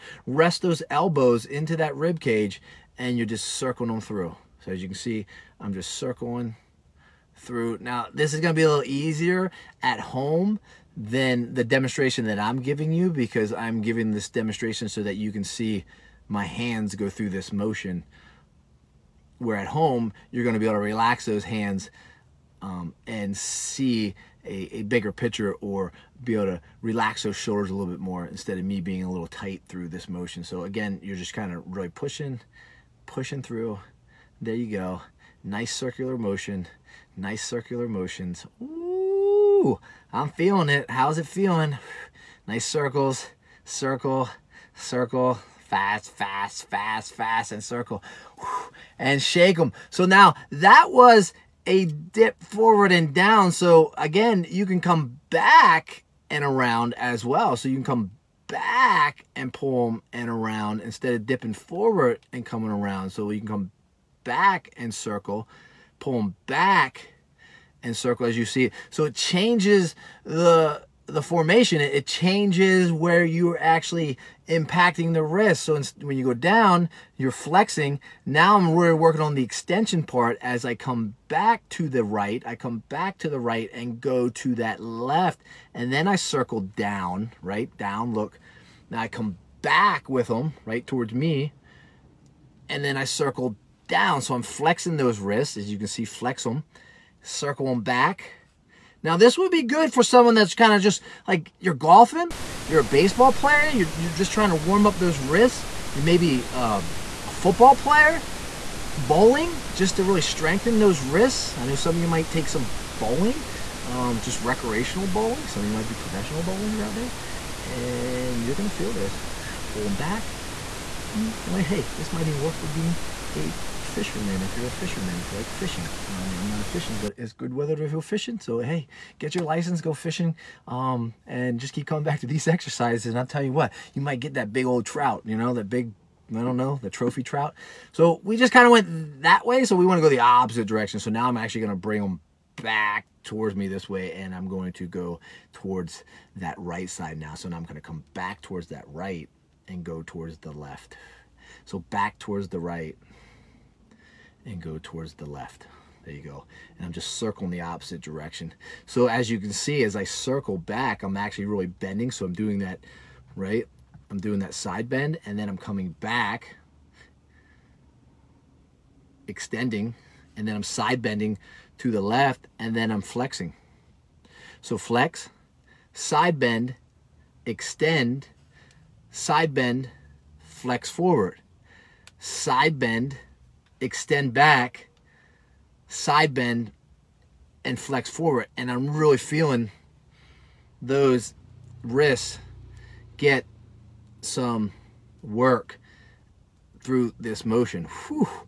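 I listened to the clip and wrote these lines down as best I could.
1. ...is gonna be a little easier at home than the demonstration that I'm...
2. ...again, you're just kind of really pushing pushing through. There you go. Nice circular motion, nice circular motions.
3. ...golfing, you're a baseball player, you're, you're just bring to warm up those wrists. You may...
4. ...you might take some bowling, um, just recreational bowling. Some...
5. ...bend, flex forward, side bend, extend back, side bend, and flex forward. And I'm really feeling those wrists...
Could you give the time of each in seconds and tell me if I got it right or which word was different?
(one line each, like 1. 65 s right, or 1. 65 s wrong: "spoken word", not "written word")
1. 8 s right
2. 30 s right
3. 101 s wrong: "trying", not "bring"
4. 112 s right
5. 179 s right.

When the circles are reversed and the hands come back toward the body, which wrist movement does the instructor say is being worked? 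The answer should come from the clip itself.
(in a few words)
extension.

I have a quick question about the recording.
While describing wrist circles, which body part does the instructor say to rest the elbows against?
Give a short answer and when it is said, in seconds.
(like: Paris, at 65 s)
rib cage, at 1 s.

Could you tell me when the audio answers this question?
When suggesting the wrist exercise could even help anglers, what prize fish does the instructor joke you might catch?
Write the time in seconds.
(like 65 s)
136 s.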